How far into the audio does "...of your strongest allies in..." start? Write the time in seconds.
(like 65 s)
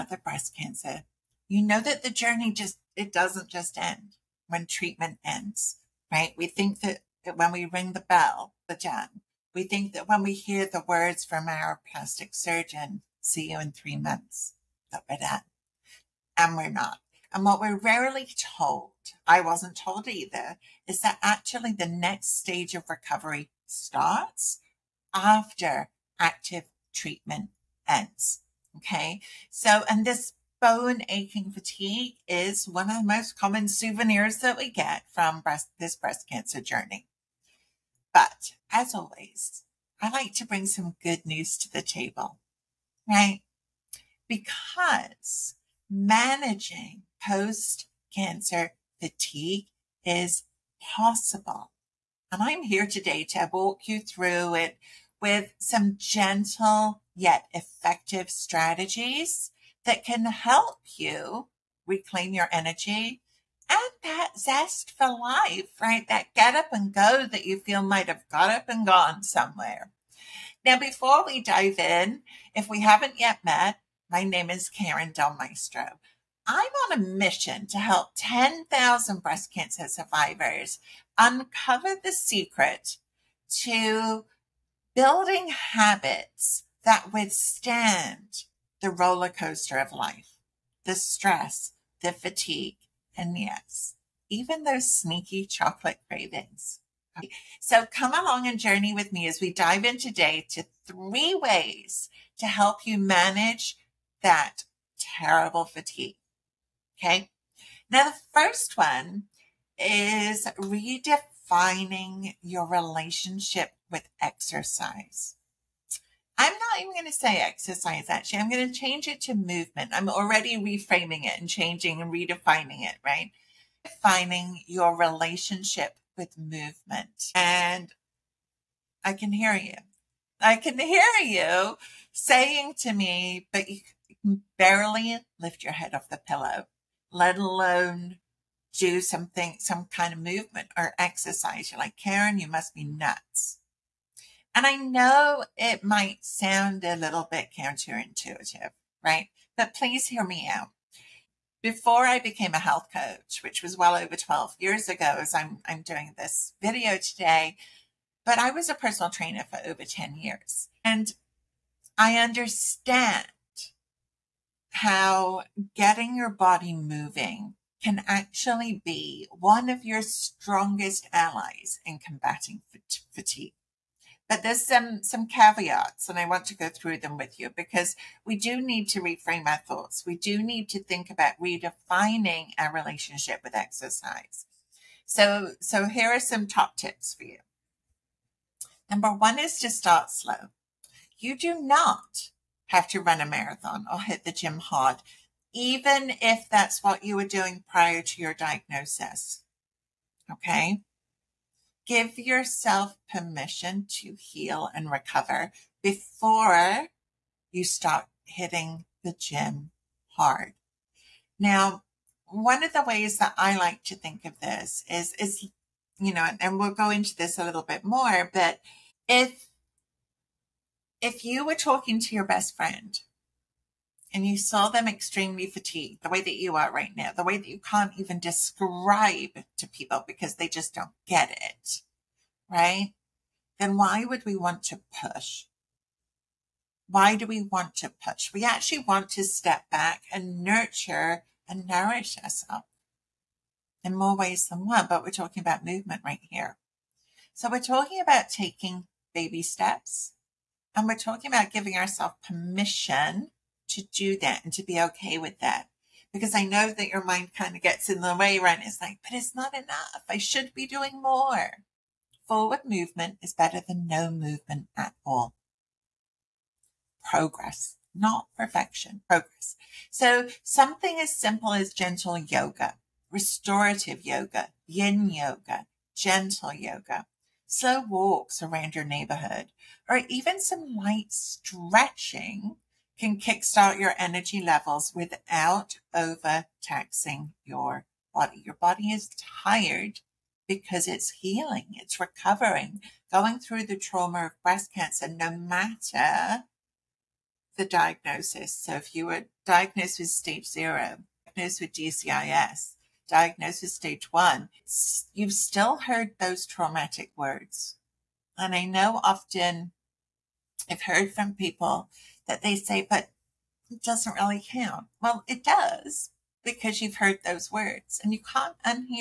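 169 s.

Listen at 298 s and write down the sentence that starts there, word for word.
So if you were diagnosed with stage zero, diagnosed with DCIS, diagnosed with stage one, you've still heard those traumatic words.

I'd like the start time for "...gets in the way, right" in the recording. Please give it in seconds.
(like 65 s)
257 s.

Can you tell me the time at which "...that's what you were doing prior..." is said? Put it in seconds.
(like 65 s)
196 s.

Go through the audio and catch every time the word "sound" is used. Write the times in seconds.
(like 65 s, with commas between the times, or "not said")
146 s.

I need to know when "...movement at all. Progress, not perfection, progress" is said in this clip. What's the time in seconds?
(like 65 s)
264 s.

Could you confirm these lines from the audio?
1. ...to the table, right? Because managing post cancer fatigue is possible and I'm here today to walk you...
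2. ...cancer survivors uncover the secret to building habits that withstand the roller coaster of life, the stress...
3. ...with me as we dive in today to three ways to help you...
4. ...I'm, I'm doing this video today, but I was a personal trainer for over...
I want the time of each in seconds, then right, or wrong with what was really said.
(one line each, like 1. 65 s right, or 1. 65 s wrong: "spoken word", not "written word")
1. 41 s right
2. 79 s right
3. 98 s right
4. 155 s right.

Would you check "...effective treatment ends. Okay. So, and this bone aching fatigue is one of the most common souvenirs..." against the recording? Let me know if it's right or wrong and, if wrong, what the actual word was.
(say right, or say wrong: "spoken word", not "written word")
wrong: "active", not "effective".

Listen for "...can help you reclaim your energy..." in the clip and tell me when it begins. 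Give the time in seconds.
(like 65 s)
60 s.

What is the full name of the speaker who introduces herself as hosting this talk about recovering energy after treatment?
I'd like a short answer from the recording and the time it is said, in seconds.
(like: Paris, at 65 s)
Karin Del Maestro, at 74 s.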